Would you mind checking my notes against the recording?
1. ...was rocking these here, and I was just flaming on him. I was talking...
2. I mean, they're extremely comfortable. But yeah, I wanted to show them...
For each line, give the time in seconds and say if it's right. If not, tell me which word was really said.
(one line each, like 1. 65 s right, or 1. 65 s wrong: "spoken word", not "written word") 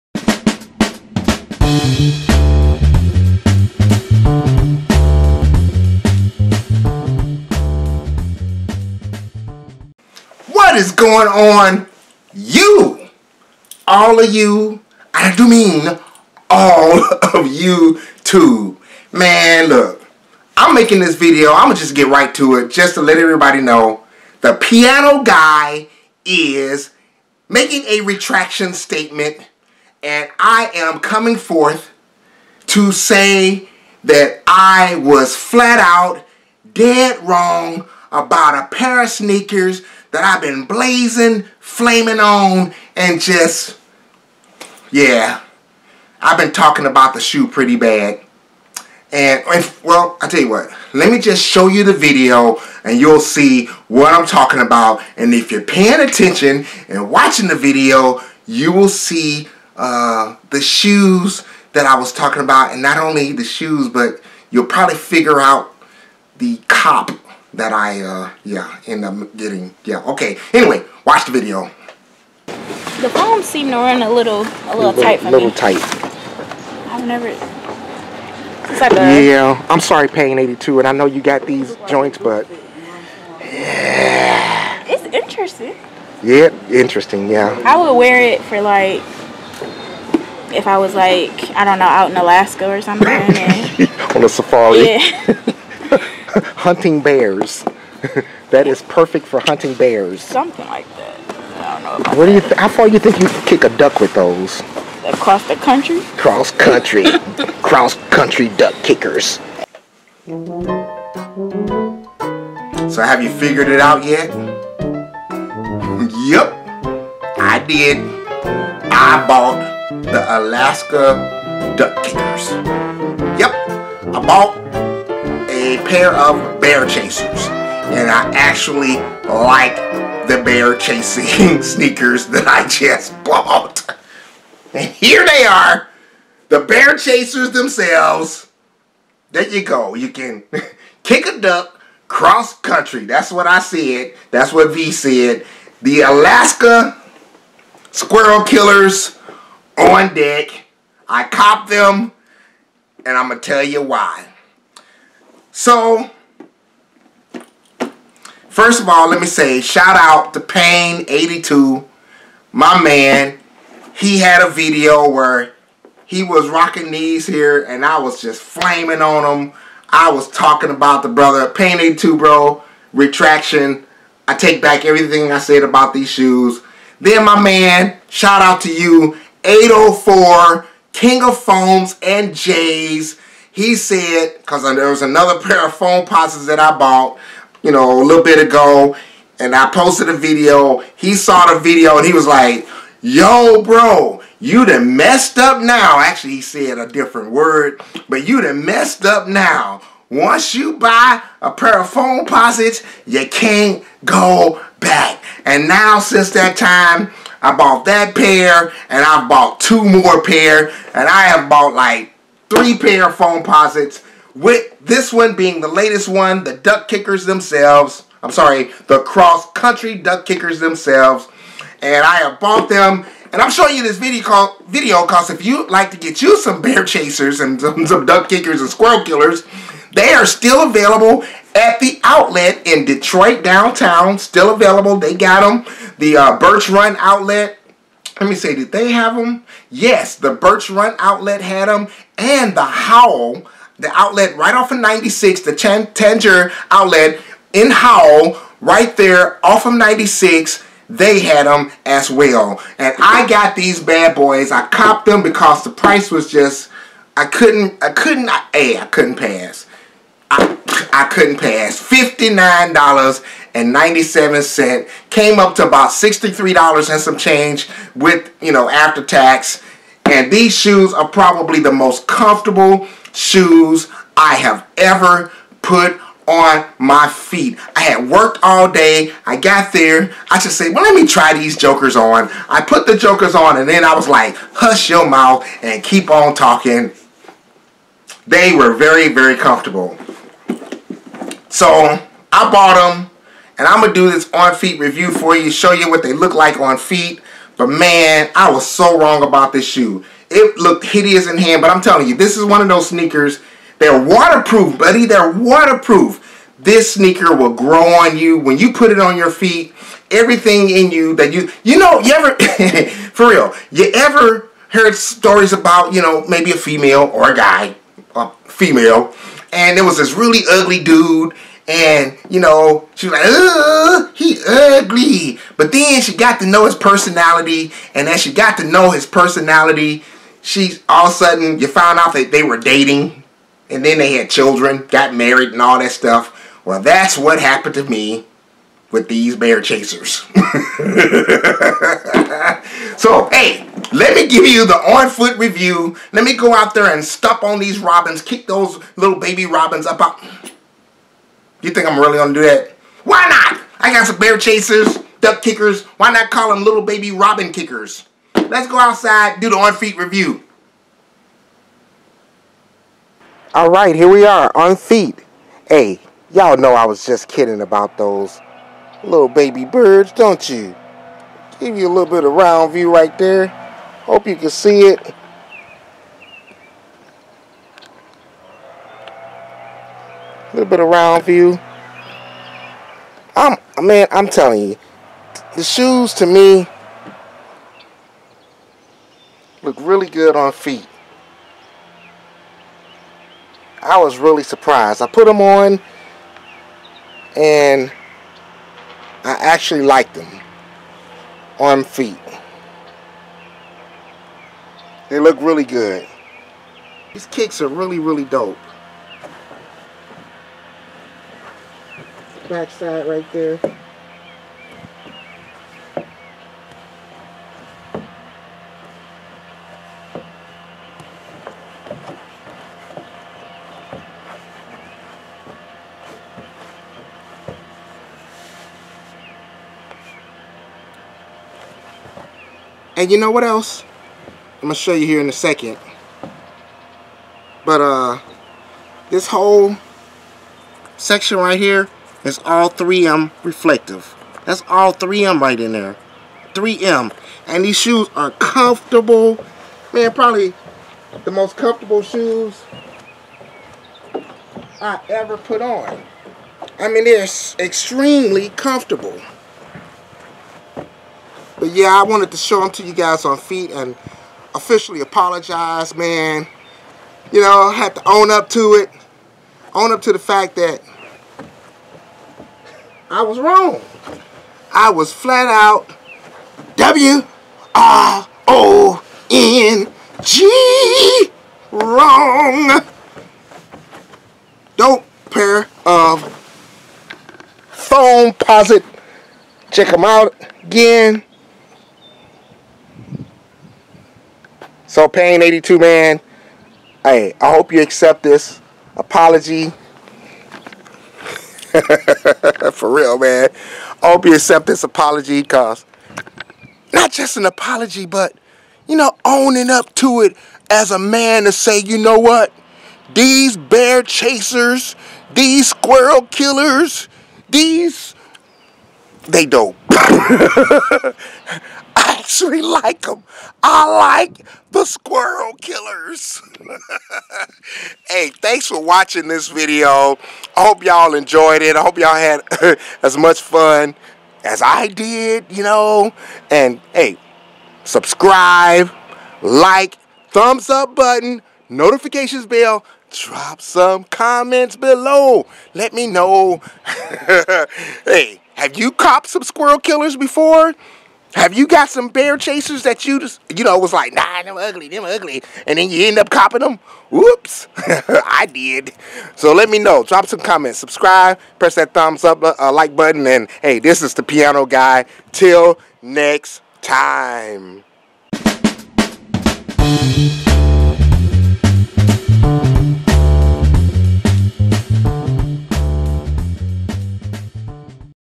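1. 166 s right
2. 456 s right.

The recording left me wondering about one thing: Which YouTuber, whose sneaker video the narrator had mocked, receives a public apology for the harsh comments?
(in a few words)
Pain82.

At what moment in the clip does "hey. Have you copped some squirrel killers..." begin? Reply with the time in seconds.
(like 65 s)
548 s.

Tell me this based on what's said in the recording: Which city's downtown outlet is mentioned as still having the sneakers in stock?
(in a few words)
Detroit.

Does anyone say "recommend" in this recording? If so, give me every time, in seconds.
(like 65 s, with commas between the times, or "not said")
not said.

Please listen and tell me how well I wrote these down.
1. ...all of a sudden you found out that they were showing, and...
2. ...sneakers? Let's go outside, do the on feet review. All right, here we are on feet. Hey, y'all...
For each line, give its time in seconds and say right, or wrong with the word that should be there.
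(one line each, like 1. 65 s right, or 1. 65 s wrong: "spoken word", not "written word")
1. 330 s wrong: "dating", not "showing"
2. 357 s wrong: "kickers", not "sneakers".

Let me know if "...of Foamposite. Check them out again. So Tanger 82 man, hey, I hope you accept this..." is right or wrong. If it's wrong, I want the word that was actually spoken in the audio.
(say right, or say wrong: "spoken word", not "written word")
wrong: "Pain", not "Tanger".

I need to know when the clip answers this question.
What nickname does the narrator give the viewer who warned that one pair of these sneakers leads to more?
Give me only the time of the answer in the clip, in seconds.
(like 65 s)
179 s.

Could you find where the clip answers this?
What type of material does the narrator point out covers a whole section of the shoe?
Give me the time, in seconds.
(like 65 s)
442 s.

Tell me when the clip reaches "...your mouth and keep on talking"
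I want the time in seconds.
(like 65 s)
284 s.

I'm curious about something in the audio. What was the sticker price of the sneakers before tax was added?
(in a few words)
$59.97.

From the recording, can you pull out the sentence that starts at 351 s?
You think I'm really gonna do that?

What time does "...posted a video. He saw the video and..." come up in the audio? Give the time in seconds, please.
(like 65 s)
189 s.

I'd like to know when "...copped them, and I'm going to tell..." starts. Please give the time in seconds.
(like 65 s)
151 s.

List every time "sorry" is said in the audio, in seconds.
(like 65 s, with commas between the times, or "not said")
79 s, 218 s.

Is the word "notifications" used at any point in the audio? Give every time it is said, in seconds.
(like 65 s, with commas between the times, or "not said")
541 s.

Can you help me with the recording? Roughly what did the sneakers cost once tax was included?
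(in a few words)
About $63.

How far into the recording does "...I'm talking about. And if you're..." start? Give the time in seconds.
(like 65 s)
54 s.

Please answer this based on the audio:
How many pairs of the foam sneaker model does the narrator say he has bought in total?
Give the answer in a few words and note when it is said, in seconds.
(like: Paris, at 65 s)
3, at 212 s.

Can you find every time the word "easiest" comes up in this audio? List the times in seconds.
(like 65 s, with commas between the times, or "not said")
not said.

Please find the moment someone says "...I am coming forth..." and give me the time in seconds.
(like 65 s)
30 s.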